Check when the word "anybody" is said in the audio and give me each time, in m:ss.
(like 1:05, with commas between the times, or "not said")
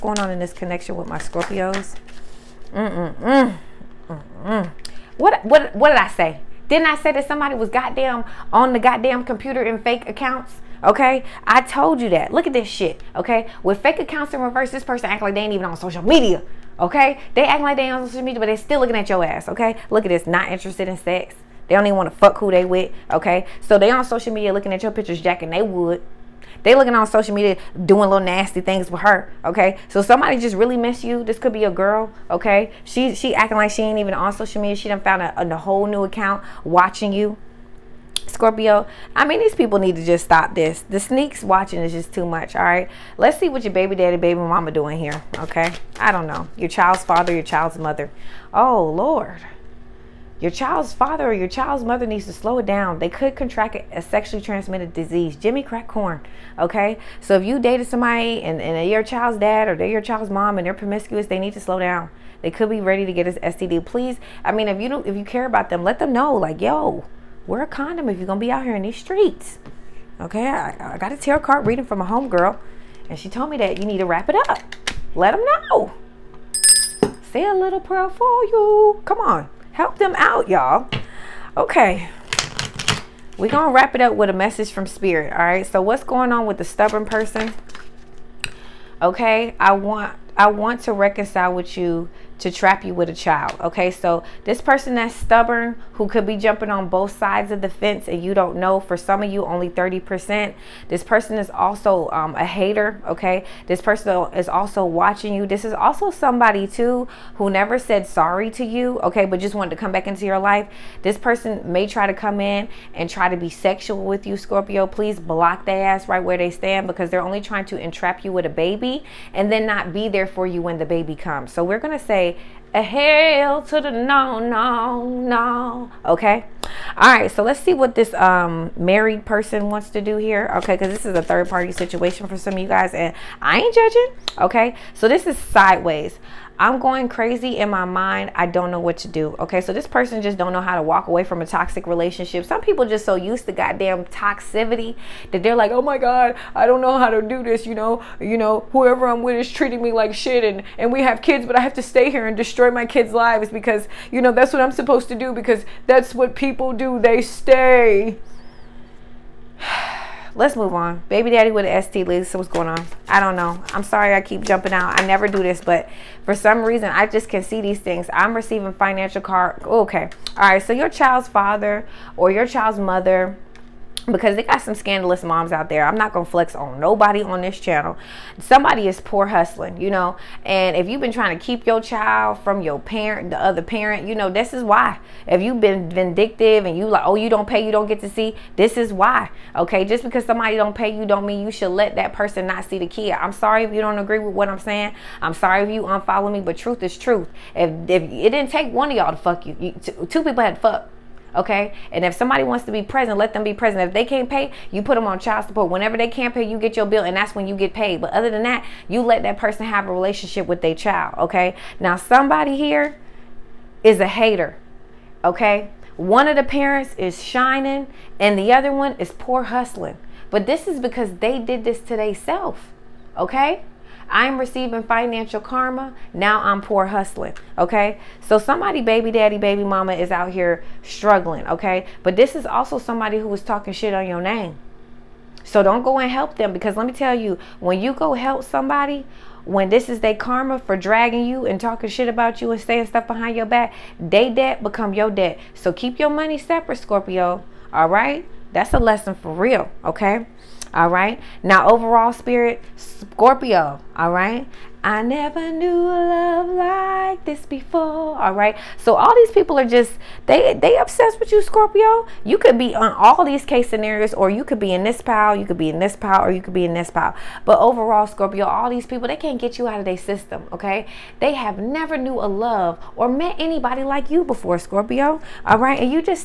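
4:33.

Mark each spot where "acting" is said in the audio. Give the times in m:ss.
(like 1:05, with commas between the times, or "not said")
0:17, 0:33.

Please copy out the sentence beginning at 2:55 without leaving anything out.
I'm not going to flex on nobody on this channel.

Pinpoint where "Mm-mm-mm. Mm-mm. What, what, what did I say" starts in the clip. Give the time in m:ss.
0:02.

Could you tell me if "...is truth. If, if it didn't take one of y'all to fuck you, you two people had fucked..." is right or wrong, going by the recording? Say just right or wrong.
right.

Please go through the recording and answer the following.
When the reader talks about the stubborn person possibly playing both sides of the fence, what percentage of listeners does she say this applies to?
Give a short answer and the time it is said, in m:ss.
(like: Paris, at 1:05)
30%, at 1:39.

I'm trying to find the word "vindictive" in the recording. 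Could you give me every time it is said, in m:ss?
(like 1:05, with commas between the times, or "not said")
3:05.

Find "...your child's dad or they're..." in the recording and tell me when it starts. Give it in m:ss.
0:58.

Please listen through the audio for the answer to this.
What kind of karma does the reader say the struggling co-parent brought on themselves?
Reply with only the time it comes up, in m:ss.
3:44.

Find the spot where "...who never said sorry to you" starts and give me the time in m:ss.
1:47.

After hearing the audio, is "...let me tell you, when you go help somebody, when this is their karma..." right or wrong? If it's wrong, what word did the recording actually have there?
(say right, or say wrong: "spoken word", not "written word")
right.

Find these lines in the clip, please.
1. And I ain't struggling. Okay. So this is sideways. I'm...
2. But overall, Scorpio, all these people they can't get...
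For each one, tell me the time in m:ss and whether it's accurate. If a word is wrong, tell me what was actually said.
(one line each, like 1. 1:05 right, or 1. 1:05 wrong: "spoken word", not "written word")
1. 2:12 wrong: "judging", not "struggling"
2. 4:27 right.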